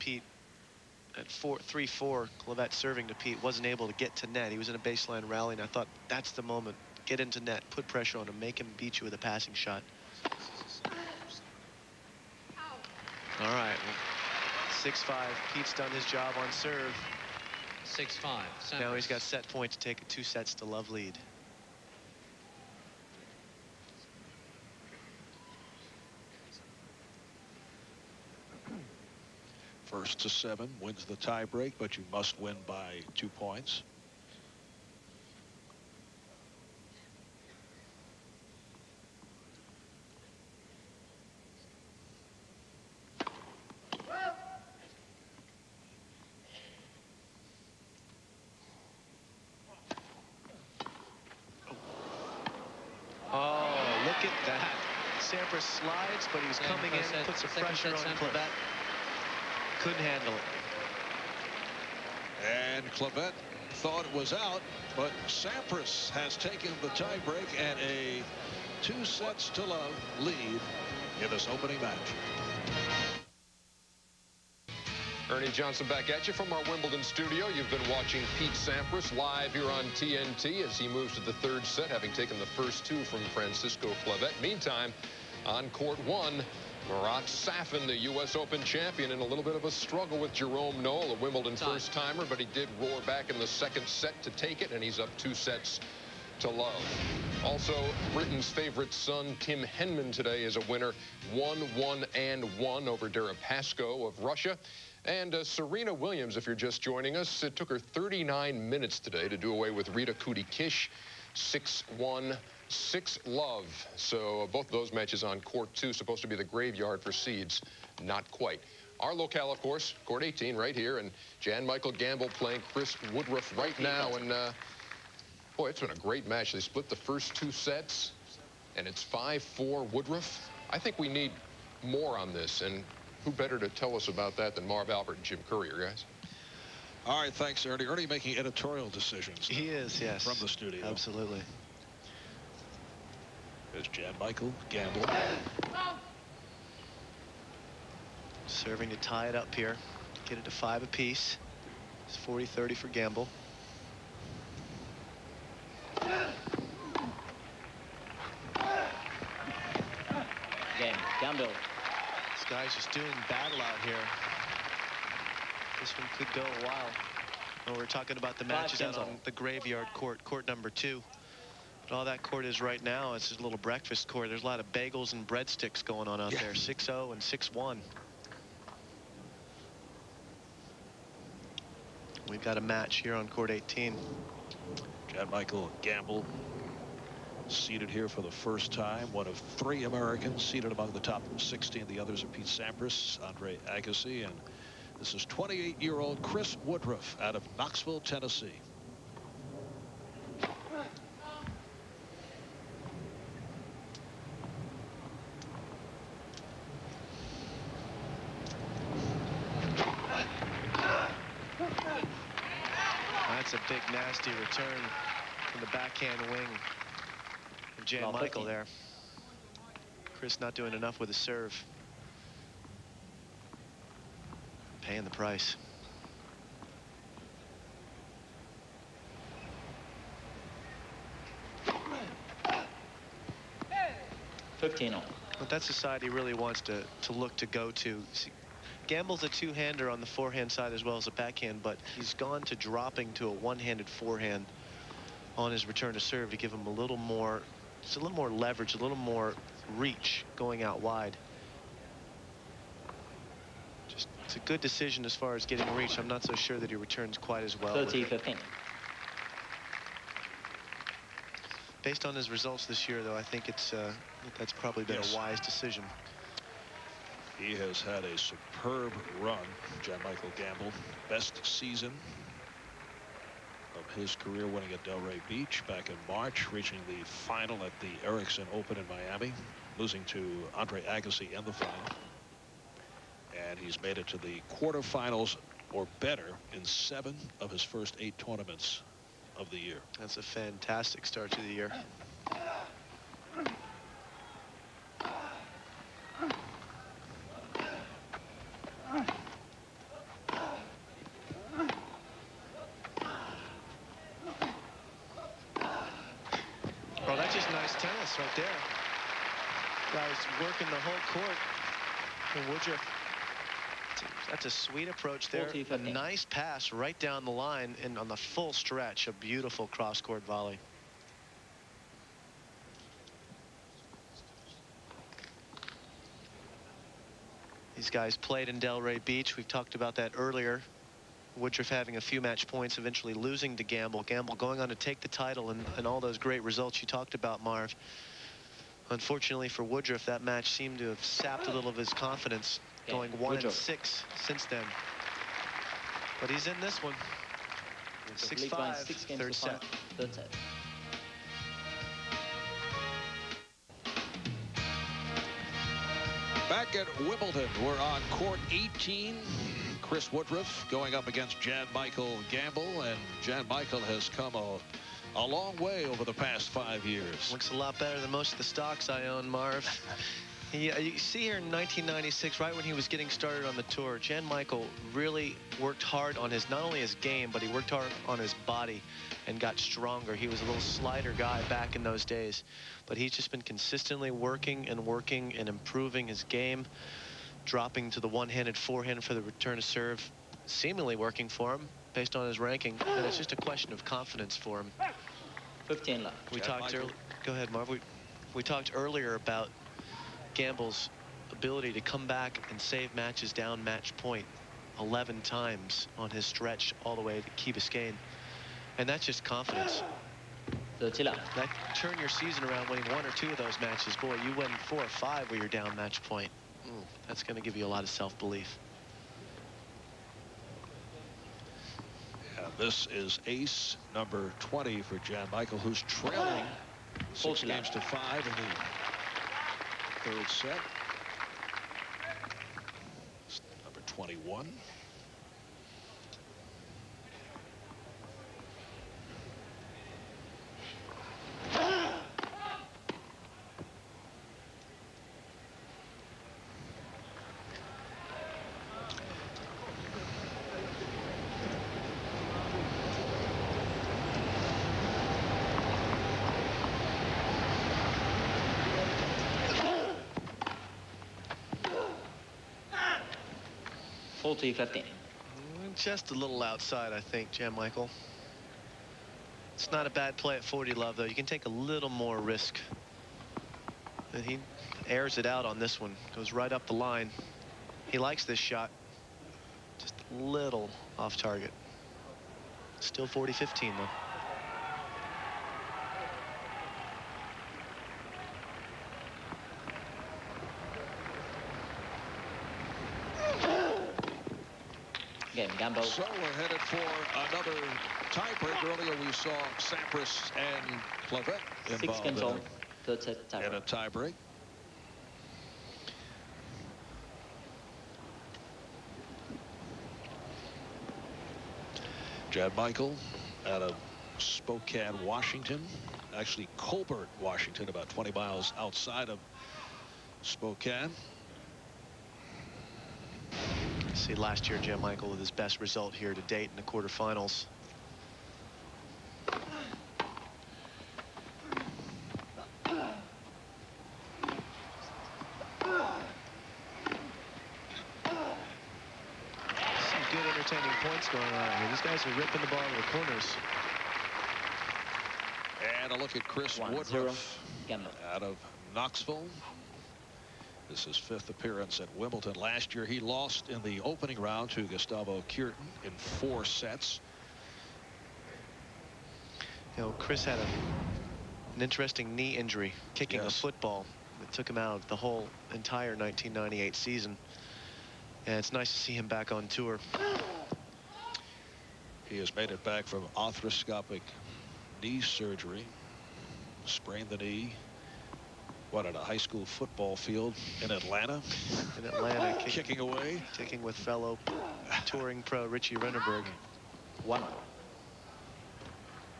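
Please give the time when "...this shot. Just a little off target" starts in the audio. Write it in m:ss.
7:58.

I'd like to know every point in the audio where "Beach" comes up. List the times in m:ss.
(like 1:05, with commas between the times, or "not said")
4:35, 5:29.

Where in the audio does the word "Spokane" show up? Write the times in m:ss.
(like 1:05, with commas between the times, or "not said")
8:34, 8:40.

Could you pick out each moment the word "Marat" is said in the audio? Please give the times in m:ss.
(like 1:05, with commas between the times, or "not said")
1:26.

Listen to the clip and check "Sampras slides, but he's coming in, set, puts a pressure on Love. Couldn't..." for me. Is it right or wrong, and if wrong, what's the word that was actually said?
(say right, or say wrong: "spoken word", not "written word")
wrong: "Clavet", not "Love".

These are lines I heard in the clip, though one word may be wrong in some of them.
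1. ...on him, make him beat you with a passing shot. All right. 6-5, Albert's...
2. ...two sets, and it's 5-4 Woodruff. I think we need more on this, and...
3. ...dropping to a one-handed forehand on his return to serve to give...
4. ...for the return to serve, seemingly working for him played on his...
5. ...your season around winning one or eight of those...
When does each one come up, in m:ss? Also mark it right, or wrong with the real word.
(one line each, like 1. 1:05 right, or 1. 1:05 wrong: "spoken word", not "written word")
1. 0:08 wrong: "Pete", not "Albert"
2. 2:07 right
3. 4:02 right
4. 6:29 wrong: "based", not "played"
5. 6:51 wrong: "two", not "eight".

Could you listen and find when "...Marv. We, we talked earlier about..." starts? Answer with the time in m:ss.
6:37.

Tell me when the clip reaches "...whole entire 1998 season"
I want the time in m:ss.
9:24.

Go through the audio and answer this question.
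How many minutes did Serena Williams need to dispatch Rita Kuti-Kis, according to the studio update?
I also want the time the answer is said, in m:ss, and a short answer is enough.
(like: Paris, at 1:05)
39, at 1:47.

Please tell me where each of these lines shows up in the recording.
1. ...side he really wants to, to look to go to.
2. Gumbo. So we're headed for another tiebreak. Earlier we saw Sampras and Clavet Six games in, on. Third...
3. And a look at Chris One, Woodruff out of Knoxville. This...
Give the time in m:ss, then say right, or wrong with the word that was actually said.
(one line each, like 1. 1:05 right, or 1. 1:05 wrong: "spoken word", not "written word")
1. 3:55 right
2. 8:15 right
3. 9:05 right.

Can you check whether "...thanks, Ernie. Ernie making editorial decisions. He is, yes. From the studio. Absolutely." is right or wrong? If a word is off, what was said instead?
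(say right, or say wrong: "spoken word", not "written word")
right.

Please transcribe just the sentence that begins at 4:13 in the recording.
Just, it's a good decision as far as getting reach.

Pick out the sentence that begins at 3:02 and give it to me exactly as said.
We've got a match here on court 18.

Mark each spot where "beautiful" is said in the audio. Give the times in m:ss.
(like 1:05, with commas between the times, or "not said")
5:19.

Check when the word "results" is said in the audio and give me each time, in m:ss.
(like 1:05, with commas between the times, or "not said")
4:22, 5:36, 8:45.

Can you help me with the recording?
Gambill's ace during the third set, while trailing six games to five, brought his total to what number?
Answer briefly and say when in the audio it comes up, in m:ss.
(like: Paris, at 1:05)
20, at 7:03.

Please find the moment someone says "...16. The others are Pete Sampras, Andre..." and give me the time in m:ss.
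3:11.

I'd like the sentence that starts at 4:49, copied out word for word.
That's a fantastic start to the year.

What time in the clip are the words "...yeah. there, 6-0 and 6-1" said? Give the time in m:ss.
2:56.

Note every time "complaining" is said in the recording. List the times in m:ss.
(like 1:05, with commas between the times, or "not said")
not said.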